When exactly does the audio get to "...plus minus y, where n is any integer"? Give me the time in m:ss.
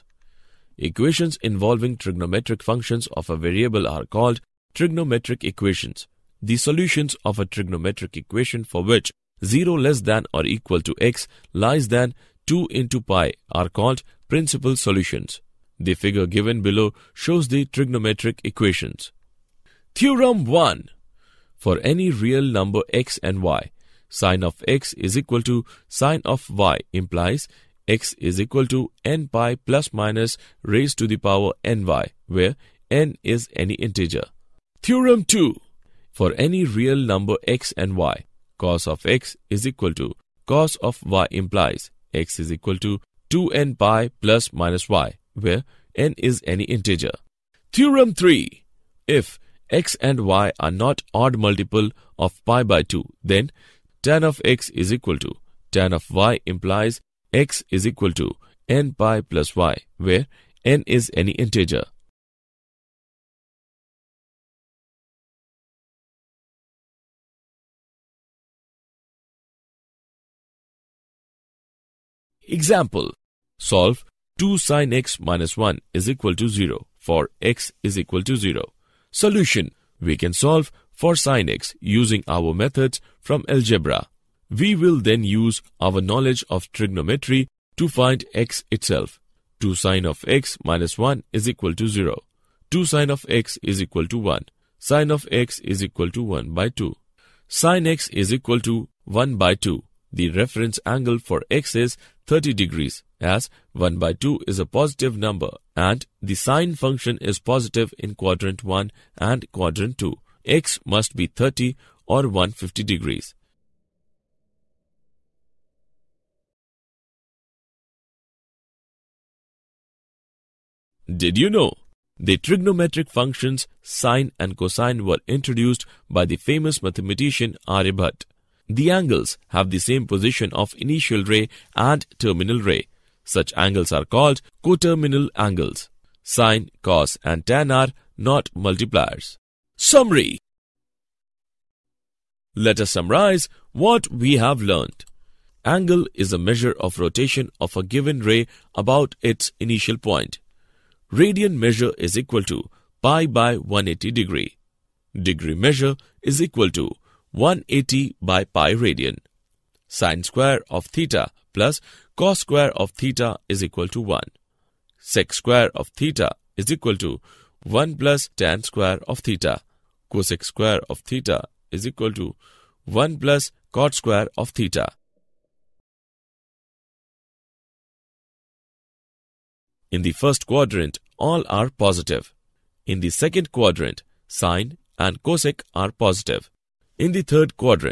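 0:44.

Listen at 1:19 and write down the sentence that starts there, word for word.
Solution, we can solve for sine x using our methods from algebra.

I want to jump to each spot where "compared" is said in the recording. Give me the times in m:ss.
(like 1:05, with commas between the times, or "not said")
not said.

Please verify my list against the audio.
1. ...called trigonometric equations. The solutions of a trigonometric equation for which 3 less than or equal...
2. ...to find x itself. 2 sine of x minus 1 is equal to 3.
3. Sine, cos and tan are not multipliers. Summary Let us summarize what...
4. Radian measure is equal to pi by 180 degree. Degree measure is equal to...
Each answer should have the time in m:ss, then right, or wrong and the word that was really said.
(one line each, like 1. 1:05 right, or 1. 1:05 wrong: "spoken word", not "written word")
1. 0:04 wrong: "0", not "3"
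2. 1:27 wrong: "0", not "3"
3. 2:16 right
4. 2:31 right.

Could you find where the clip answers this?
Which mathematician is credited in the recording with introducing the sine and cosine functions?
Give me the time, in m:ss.
2:07.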